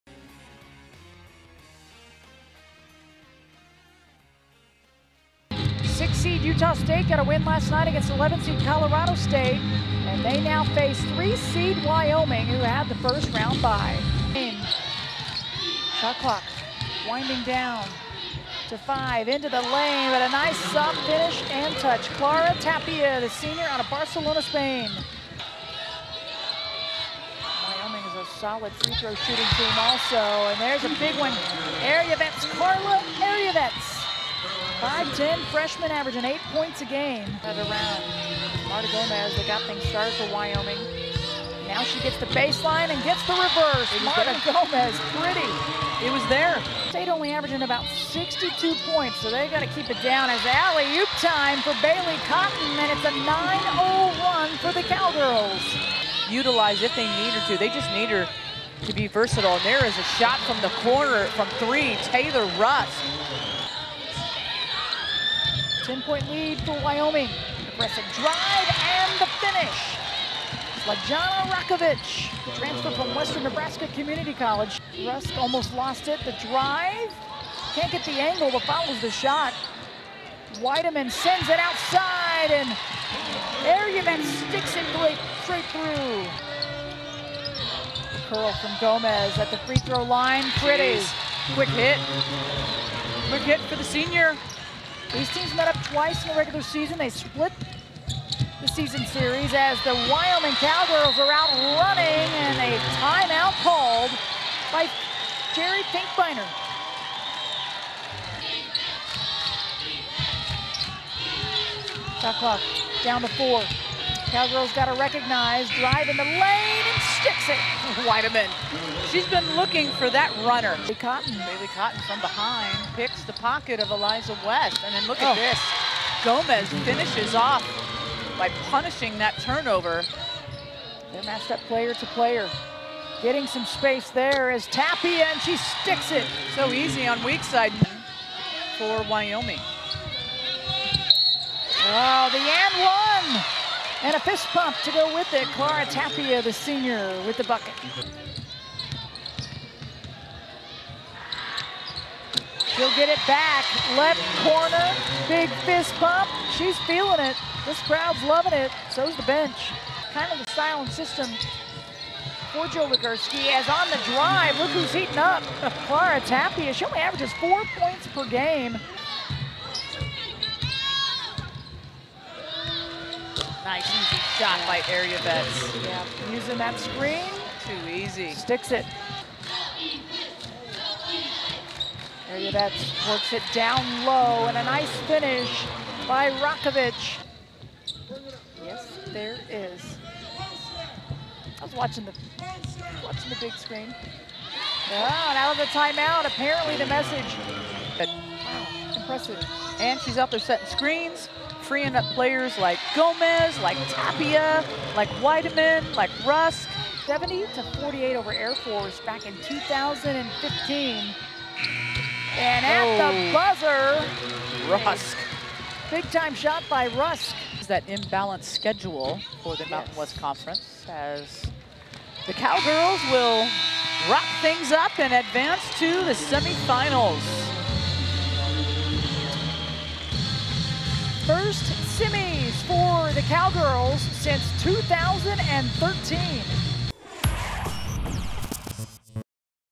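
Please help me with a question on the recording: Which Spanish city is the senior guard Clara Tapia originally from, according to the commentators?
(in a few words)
Barcelona.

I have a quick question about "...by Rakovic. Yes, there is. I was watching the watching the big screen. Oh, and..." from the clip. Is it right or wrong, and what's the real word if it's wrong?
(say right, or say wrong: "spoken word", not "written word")
right.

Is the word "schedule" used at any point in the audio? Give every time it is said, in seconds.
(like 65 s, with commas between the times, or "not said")
218 s.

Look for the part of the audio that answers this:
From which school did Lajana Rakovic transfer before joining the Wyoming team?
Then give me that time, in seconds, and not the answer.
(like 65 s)
73 s.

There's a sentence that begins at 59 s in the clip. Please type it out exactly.
And there is a shot from the corner from three, Taylor Rusk.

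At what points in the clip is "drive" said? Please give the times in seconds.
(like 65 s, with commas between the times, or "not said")
68 s, 76 s, 115 s, 164 s.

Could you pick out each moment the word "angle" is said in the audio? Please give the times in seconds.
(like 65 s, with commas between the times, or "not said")
78 s.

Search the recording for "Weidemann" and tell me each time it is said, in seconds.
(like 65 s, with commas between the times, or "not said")
80 s, 118 s, 205 s.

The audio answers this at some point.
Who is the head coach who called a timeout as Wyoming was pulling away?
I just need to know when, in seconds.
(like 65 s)
105 s.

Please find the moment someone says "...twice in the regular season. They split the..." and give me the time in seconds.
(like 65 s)
95 s.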